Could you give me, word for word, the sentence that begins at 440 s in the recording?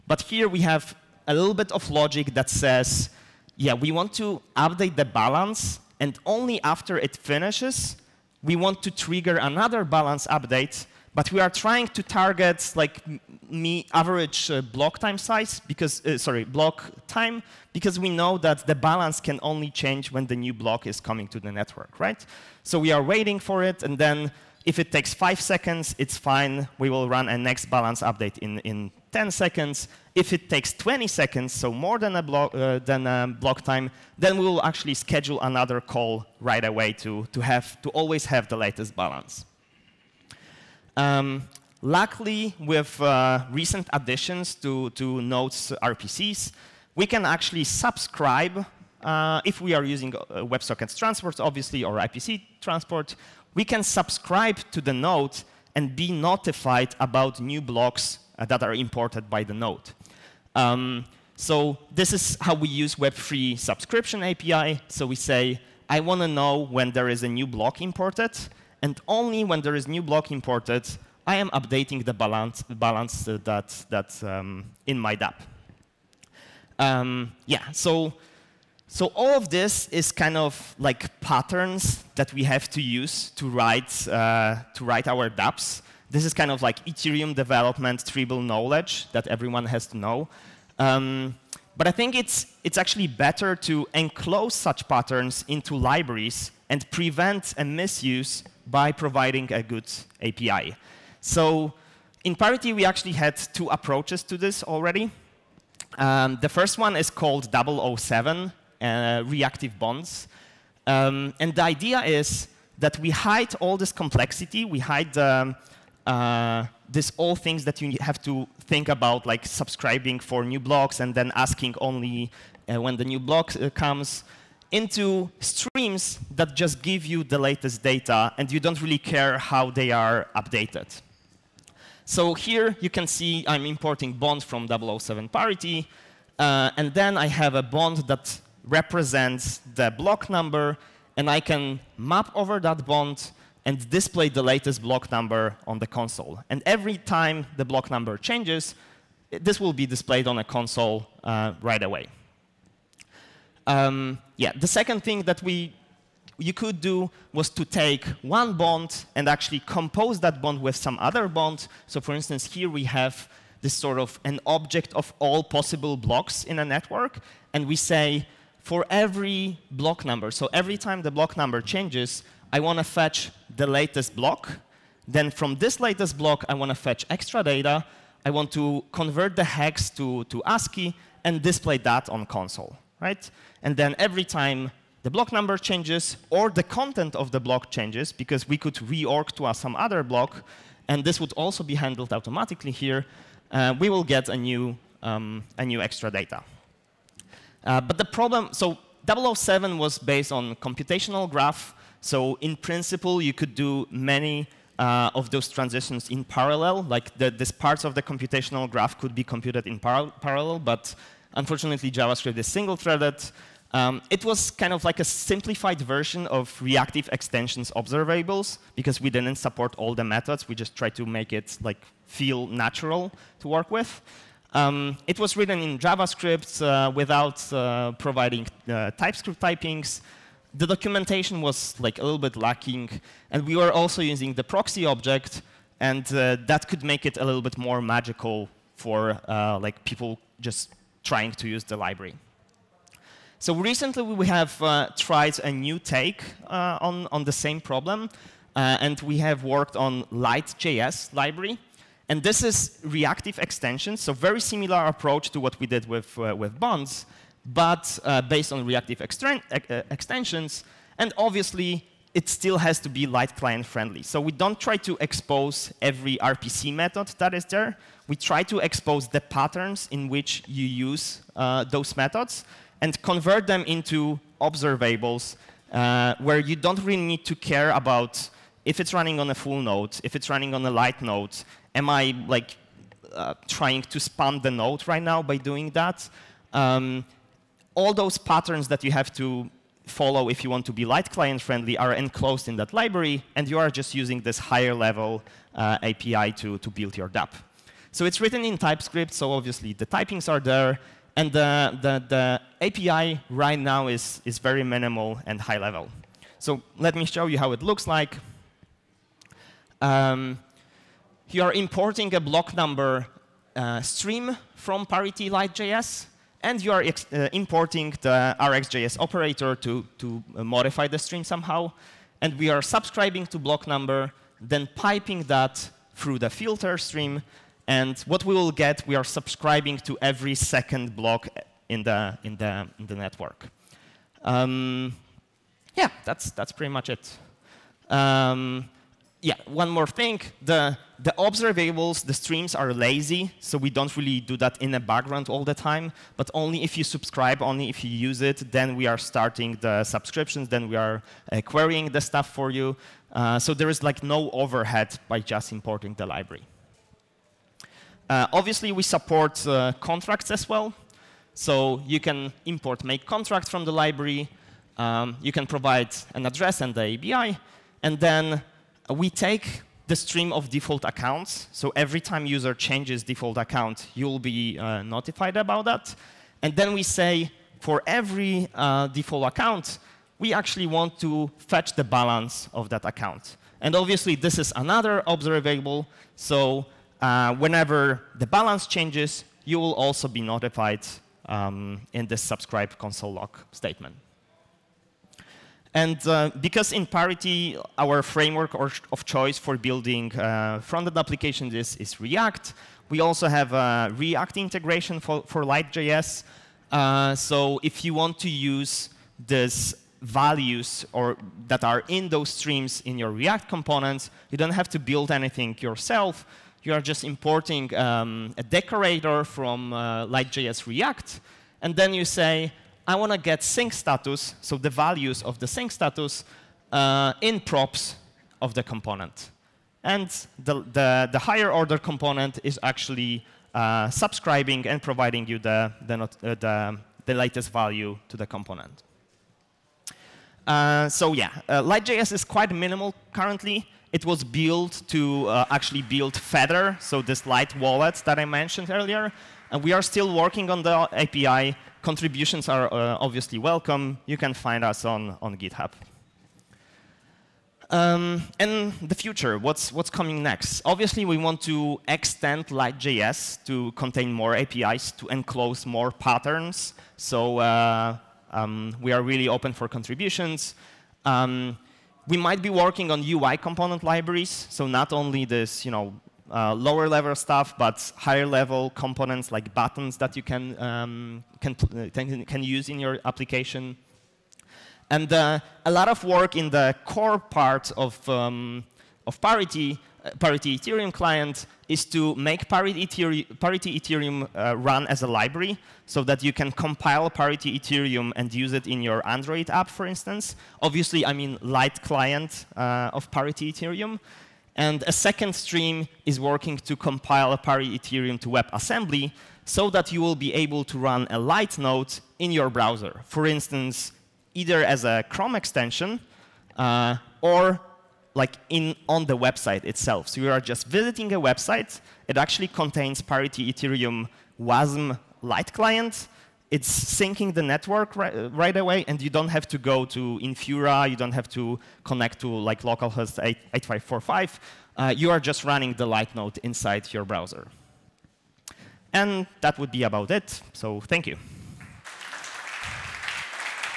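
Uh, so yeah, uh, Light.js is quite minimal currently.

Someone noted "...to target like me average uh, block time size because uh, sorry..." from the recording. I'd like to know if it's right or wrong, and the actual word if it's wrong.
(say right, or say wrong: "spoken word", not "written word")
right.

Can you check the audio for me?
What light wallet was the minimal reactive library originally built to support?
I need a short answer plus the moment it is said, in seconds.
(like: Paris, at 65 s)
Feather, at 446 s.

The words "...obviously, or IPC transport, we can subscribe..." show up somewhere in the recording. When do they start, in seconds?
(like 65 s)
51 s.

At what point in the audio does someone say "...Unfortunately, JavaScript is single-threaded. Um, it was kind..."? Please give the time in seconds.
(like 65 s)
211 s.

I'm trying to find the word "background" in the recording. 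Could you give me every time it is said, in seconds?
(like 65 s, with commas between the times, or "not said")
344 s.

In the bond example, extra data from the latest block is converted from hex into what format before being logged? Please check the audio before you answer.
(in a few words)
ASCII.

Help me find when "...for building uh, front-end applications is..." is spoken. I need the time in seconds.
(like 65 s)
399 s.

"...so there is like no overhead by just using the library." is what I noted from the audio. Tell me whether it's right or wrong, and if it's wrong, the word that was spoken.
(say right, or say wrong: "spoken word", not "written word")
wrong: "importing", not "using".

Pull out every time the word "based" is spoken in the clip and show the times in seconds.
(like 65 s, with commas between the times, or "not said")
199 s, 258 s.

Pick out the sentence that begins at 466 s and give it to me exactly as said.
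So uh, um, we are really open for contributions.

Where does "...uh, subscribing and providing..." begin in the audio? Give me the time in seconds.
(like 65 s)
433 s.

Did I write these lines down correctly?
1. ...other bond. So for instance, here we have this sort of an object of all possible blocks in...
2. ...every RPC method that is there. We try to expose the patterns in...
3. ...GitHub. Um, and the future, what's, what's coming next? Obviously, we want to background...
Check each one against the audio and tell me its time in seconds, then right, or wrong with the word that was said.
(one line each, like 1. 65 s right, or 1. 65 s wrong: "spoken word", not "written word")
1. 160 s right
2. 265 s right
3. 455 s wrong: "extend", not "background".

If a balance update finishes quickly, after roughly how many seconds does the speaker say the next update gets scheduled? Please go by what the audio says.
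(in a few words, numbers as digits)
10 seconds.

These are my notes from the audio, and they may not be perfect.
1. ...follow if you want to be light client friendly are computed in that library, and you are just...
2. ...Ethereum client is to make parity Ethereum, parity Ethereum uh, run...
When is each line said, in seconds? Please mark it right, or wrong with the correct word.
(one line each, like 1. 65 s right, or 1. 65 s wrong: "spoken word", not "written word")
1. 289 s wrong: "enclosed", not "computed"
2. 490 s right.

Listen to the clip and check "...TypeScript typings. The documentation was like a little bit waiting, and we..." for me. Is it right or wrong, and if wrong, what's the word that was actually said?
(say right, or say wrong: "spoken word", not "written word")
wrong: "lacking", not "waiting".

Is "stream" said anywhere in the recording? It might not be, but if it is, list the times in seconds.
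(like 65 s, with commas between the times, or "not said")
125 s, 313 s, 320 s, 326 s, 342 s, 369 s, 412 s, 505 s.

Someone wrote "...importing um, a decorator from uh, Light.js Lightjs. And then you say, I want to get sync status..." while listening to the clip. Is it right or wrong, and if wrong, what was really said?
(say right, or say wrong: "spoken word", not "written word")
wrong: "React", not "Lightjs".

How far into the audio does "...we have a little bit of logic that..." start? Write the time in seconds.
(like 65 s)
0 s.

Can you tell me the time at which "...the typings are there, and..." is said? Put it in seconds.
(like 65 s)
299 s.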